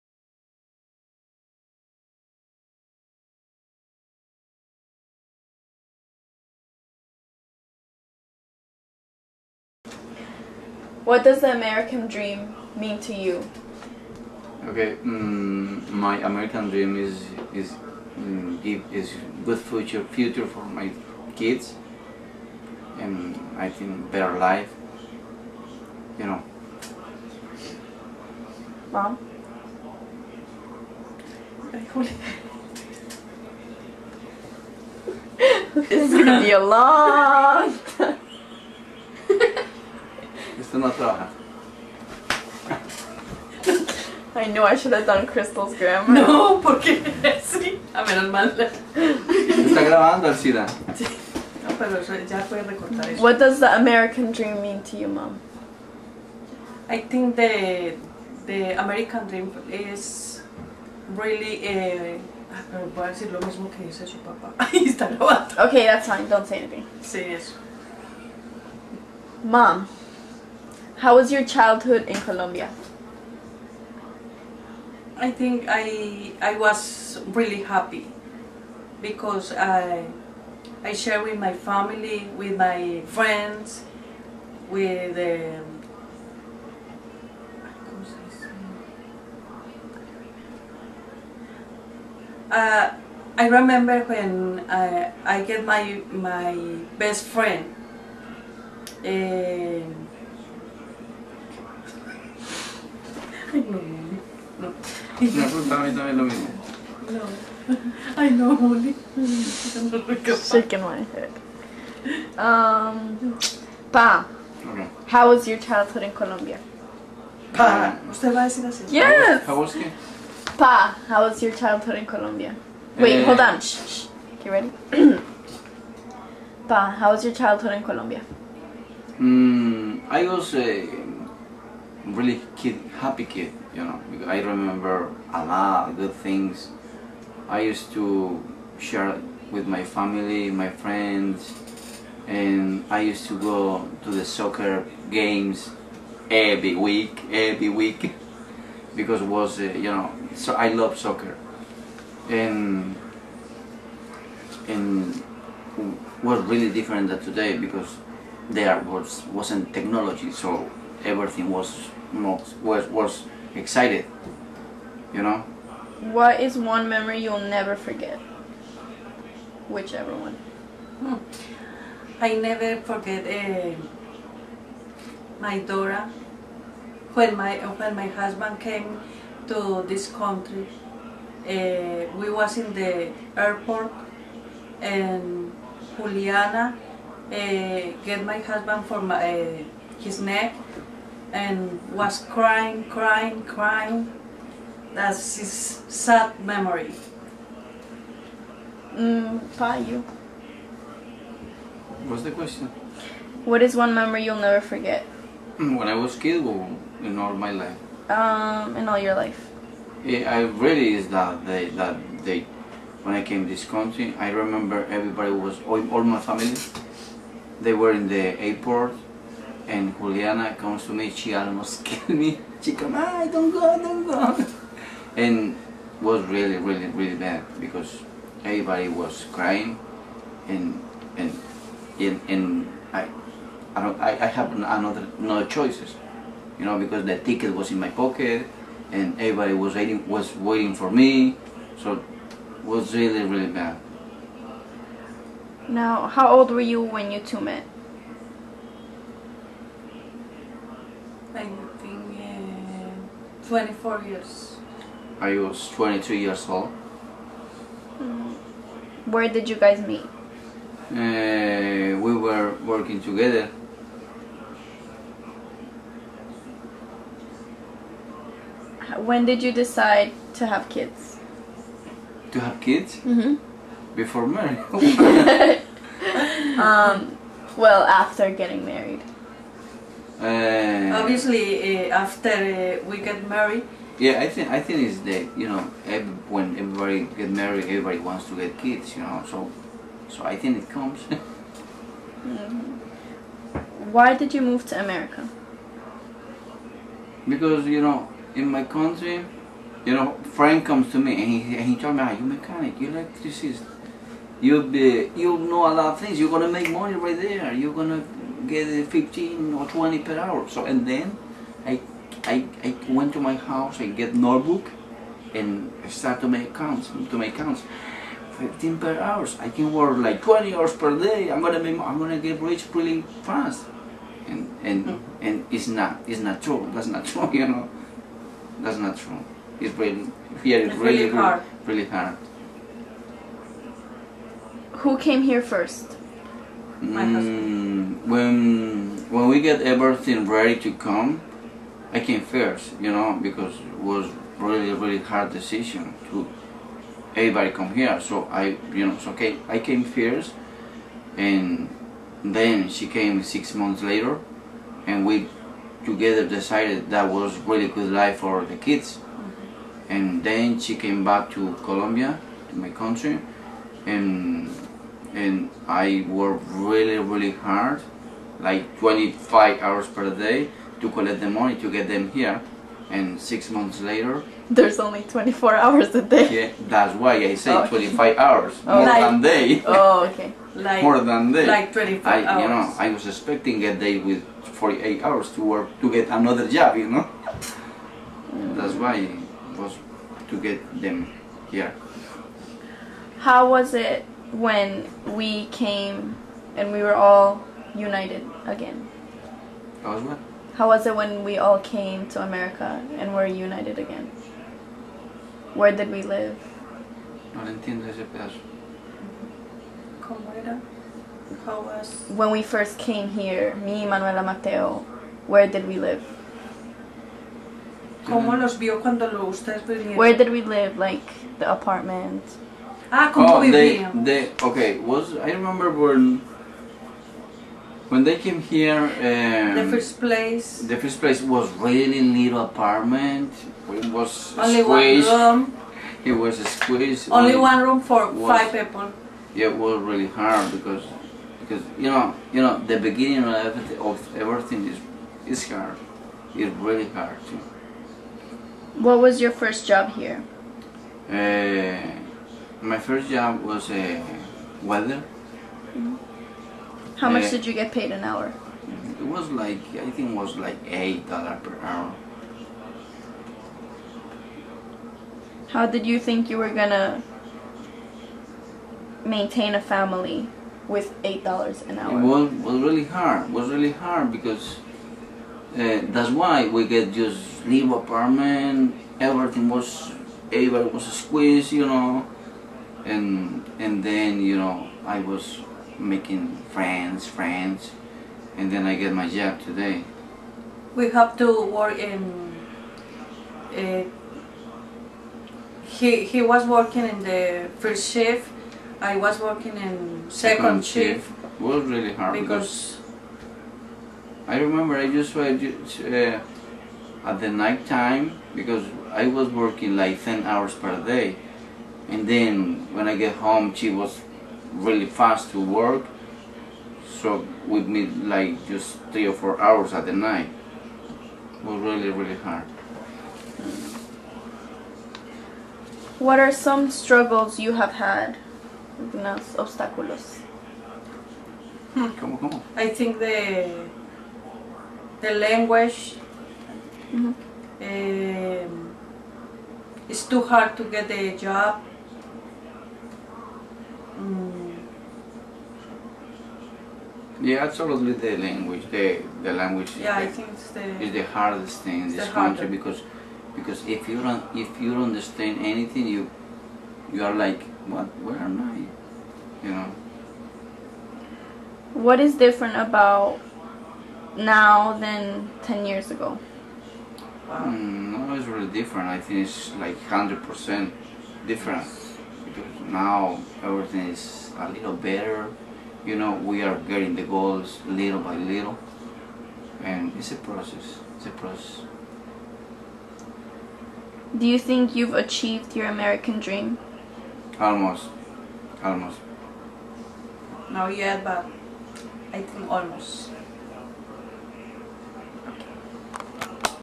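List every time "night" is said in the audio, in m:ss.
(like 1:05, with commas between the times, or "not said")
8:27, 8:39.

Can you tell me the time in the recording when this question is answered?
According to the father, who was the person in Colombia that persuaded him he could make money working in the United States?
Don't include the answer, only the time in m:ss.
5:00.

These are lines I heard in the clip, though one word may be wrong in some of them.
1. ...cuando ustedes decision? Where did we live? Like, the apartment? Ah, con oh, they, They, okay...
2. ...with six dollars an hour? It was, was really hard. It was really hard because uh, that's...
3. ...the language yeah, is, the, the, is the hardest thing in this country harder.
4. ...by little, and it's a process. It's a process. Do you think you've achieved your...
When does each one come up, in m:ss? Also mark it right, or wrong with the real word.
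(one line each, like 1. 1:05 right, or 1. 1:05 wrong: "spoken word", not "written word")
1. 6:58 wrong: "vinieron", not "decision"
2. 7:50 wrong: "eight", not "six"
3. 9:09 right
4. 9:37 right.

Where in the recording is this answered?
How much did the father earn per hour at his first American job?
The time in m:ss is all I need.
7:40.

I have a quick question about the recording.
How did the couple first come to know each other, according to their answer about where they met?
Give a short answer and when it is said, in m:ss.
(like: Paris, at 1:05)
Working together, at 4:21.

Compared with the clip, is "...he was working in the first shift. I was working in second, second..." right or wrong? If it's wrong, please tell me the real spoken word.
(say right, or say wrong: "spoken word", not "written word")
right.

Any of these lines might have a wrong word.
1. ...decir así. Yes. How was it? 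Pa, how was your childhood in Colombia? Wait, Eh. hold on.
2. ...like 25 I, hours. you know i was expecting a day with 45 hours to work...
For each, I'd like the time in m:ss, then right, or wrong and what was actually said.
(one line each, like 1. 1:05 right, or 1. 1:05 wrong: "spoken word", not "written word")
1. 1:58 right
2. 6:21 wrong: "48", not "45".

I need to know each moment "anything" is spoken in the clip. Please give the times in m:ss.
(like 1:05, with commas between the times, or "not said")
1:06, 9:15.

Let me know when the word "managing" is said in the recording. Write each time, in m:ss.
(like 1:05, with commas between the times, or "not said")
not said.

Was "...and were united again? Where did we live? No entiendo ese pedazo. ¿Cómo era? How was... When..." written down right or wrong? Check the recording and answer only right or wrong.
right.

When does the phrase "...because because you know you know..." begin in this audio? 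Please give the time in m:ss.
7:20.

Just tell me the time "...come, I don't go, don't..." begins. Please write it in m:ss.
3:42.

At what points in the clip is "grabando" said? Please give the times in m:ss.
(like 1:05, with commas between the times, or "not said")
0:49, 1:05.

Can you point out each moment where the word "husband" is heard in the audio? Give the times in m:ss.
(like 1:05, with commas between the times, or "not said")
2:58, 3:08, 5:36.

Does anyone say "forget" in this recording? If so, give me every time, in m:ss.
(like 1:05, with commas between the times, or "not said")
2:47, 2:52, 3:24.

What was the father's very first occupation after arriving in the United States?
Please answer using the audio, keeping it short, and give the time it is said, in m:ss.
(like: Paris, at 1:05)
Welder, at 7:33.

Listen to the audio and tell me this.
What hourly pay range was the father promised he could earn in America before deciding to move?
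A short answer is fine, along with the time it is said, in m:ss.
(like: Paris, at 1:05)
15 or 20 per hour, at 5:08.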